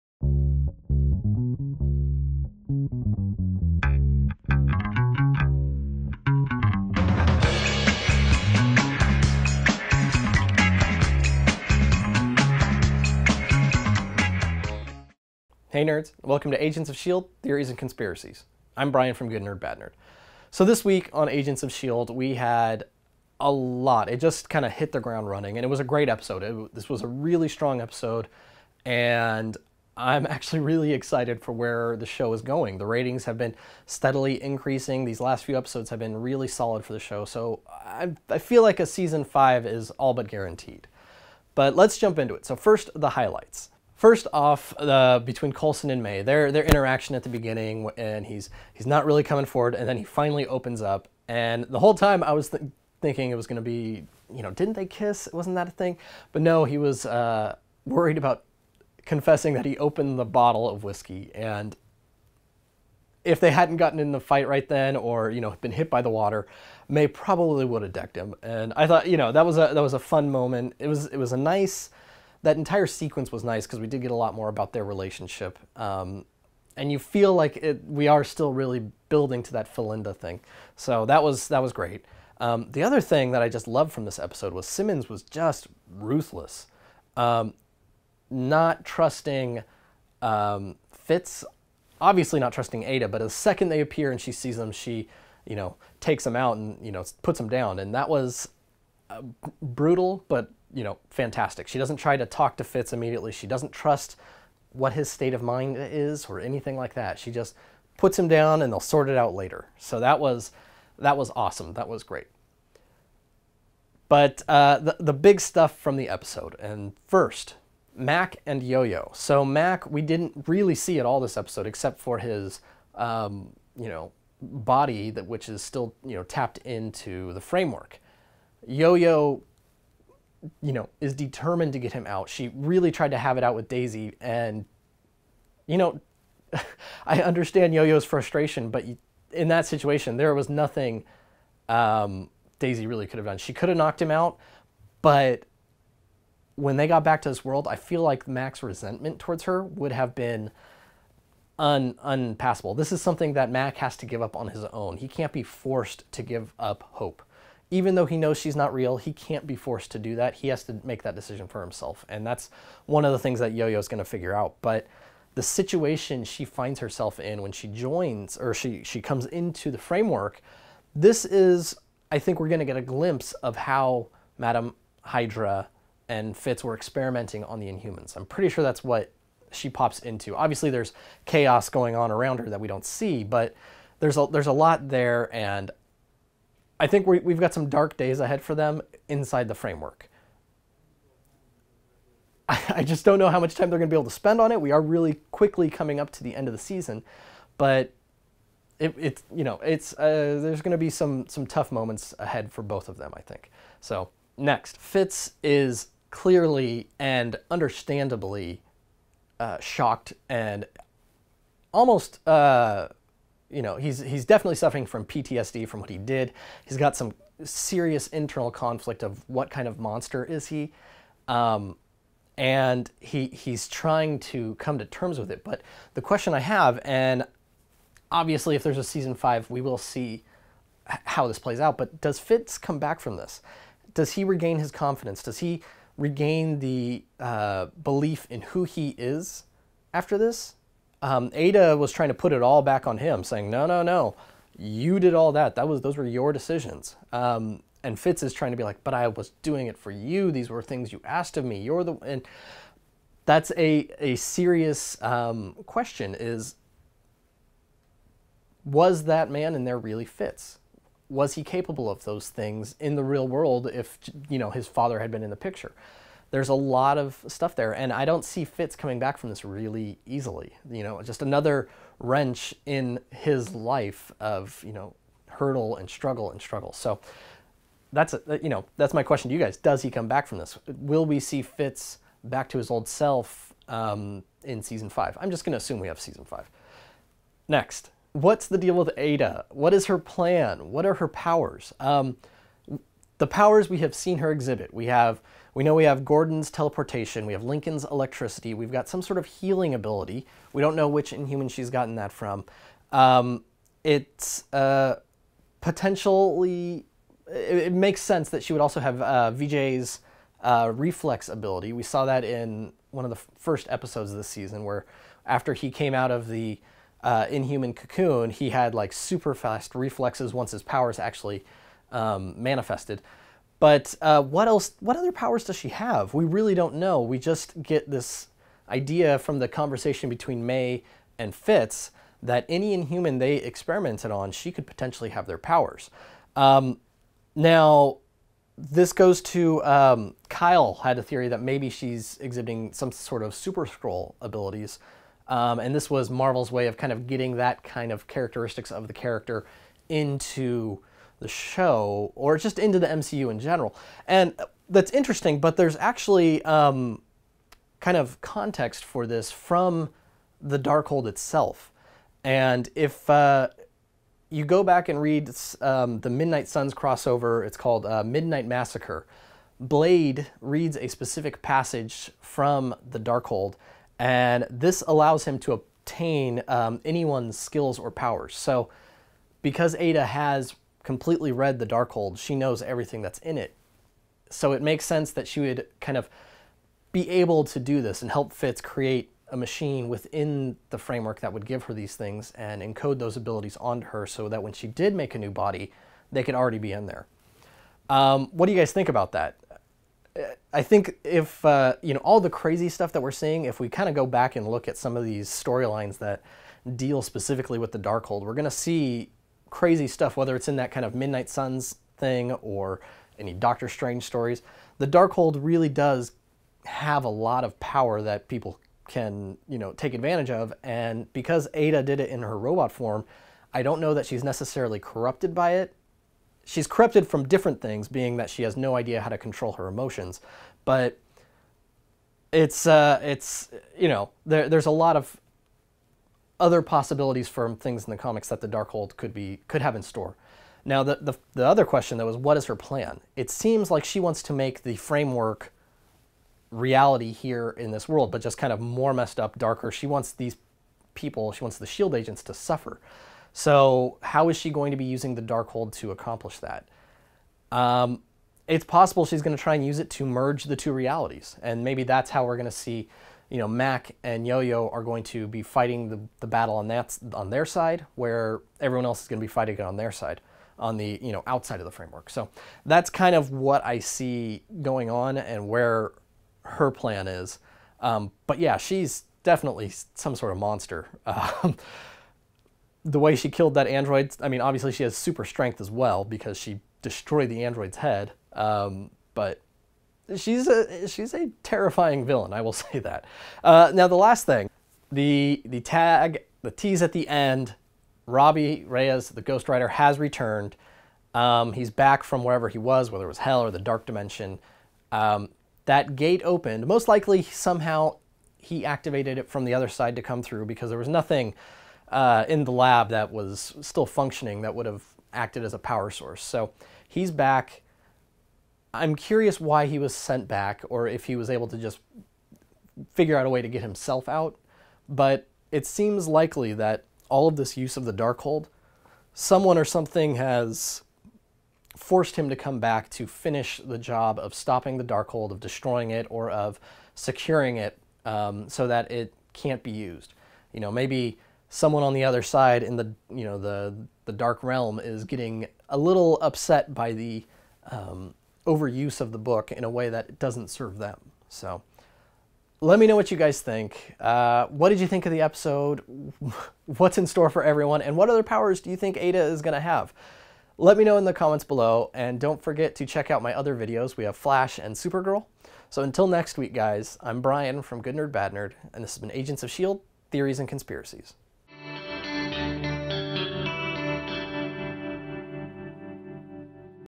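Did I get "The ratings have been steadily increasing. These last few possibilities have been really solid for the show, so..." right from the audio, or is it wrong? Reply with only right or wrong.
wrong.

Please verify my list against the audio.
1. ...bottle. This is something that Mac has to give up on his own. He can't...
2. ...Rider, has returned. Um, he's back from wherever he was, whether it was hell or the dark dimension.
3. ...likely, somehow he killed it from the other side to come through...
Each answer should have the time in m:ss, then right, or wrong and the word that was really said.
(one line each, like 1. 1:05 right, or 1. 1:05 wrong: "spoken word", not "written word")
1. 2:32 wrong: "unpassable", not "bottle"
2. 8:19 right
3. 8:26 wrong: "activated", not "killed".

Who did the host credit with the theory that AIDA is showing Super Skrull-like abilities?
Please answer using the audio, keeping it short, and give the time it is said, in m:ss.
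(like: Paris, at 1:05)
Kyle, at 5:40.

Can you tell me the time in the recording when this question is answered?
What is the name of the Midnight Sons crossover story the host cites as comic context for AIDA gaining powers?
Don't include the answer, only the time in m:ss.
6:08.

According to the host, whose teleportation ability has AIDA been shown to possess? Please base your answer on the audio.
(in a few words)
Gordon.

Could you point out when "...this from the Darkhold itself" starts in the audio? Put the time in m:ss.
5:59.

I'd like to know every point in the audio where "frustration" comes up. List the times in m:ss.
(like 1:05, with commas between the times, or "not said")
2:18.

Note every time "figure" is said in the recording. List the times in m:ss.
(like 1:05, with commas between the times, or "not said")
2:44, 8:42.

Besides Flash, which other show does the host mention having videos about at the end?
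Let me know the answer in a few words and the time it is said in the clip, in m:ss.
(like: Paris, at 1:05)
Supergirl, at 9:24.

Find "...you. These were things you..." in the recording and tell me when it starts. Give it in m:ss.
4:09.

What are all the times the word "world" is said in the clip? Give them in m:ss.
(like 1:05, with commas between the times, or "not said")
2:27, 4:23, 7:27.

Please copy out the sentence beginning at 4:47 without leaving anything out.
Next, what's the deal with AIDA?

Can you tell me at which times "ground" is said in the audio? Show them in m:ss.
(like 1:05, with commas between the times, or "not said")
0:24.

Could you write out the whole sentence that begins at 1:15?
Um, and you feel like it, we are still really building to that Philinda thing.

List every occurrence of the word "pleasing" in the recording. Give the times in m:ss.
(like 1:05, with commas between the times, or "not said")
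not said.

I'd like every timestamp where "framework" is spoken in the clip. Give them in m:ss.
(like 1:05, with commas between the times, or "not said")
2:07, 2:49, 3:09, 6:30, 7:24, 7:51.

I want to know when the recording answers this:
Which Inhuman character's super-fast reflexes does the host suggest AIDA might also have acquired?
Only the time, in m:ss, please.
5:09.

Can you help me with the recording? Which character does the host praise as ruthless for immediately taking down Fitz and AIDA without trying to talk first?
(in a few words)
Simmons.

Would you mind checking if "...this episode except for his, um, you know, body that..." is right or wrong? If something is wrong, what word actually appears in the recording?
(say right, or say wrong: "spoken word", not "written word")
right.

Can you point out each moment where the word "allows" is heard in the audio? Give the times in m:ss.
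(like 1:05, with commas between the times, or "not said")
6:14.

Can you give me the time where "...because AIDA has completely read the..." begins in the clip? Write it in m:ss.
6:19.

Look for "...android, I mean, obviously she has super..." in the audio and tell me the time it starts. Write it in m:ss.
8:03.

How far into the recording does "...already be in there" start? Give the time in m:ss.
6:36.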